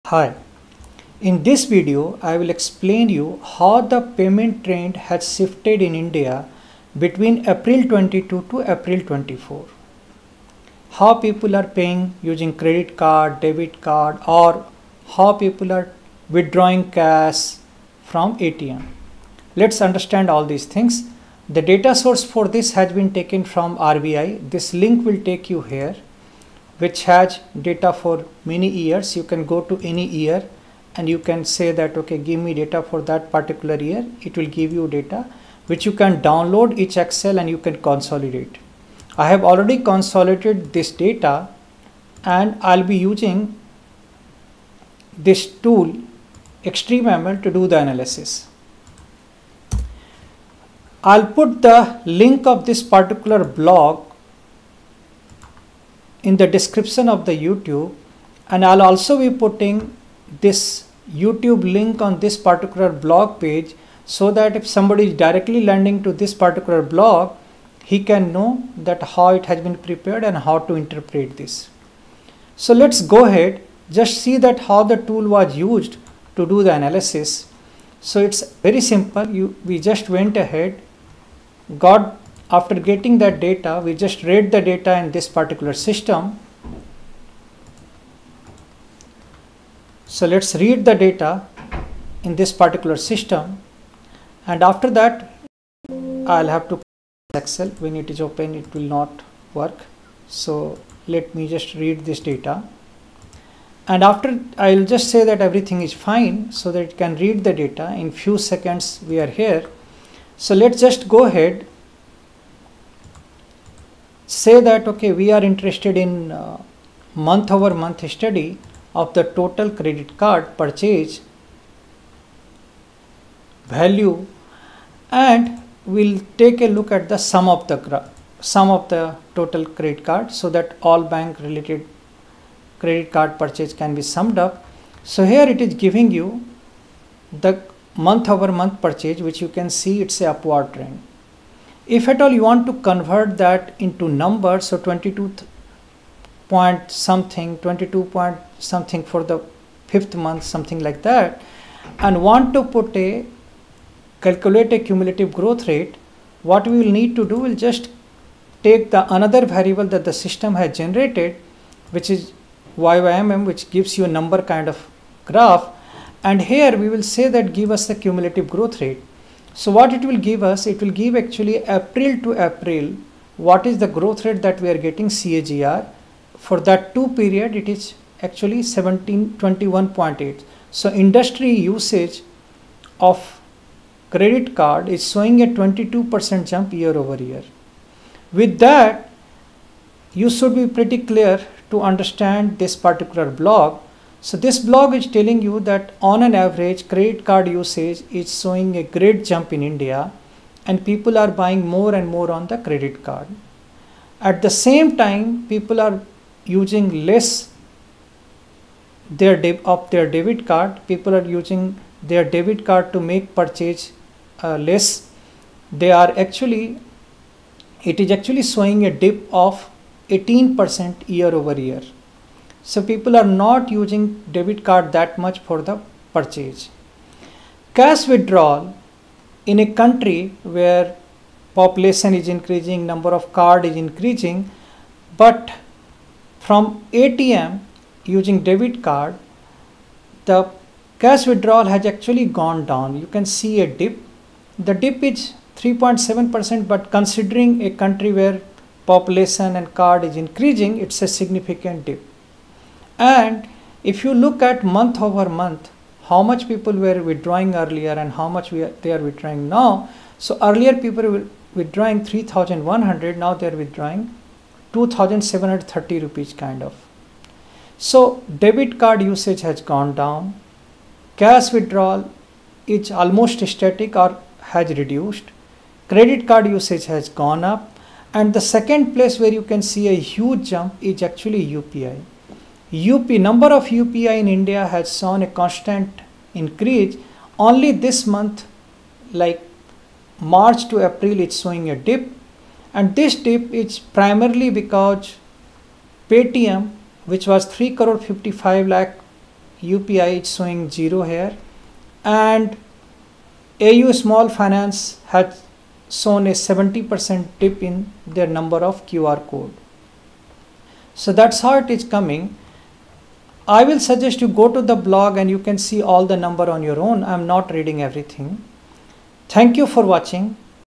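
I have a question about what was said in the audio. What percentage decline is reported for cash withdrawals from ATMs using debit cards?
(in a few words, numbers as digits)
3.7%.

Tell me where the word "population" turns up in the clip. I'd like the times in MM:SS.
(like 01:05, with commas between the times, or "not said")
03:51, 04:08.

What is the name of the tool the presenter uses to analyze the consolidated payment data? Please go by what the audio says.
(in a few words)
extreme ml.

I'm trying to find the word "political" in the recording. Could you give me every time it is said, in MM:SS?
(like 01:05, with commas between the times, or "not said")
not said.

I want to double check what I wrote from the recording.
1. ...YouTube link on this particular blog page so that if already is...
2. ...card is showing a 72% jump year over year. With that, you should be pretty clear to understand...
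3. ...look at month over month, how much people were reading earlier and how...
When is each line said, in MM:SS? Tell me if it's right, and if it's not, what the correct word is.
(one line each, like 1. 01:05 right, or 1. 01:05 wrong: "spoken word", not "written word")
1. 01:01 wrong: "somebody", not "already"
2. 03:04 wrong: "22", not "72"
3. 04:14 wrong: "withdrawing", not "reading".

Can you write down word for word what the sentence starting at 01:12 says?
So let's go ahead, just see that how the tool was used to do the analysis.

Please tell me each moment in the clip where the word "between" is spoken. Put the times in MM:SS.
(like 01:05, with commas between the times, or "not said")
00:07.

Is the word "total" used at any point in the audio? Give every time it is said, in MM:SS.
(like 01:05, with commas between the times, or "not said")
01:59, 02:09.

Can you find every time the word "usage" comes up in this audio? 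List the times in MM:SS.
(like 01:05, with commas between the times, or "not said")
03:01, 03:17, 04:29, 04:36.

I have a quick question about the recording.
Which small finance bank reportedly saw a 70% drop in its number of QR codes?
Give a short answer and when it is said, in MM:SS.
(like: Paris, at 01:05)
AU Small Finance, at 05:03.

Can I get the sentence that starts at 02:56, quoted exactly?
For that two period, it is actually seventeen twenty one point eight.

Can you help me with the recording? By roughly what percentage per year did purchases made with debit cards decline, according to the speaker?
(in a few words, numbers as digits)
18%.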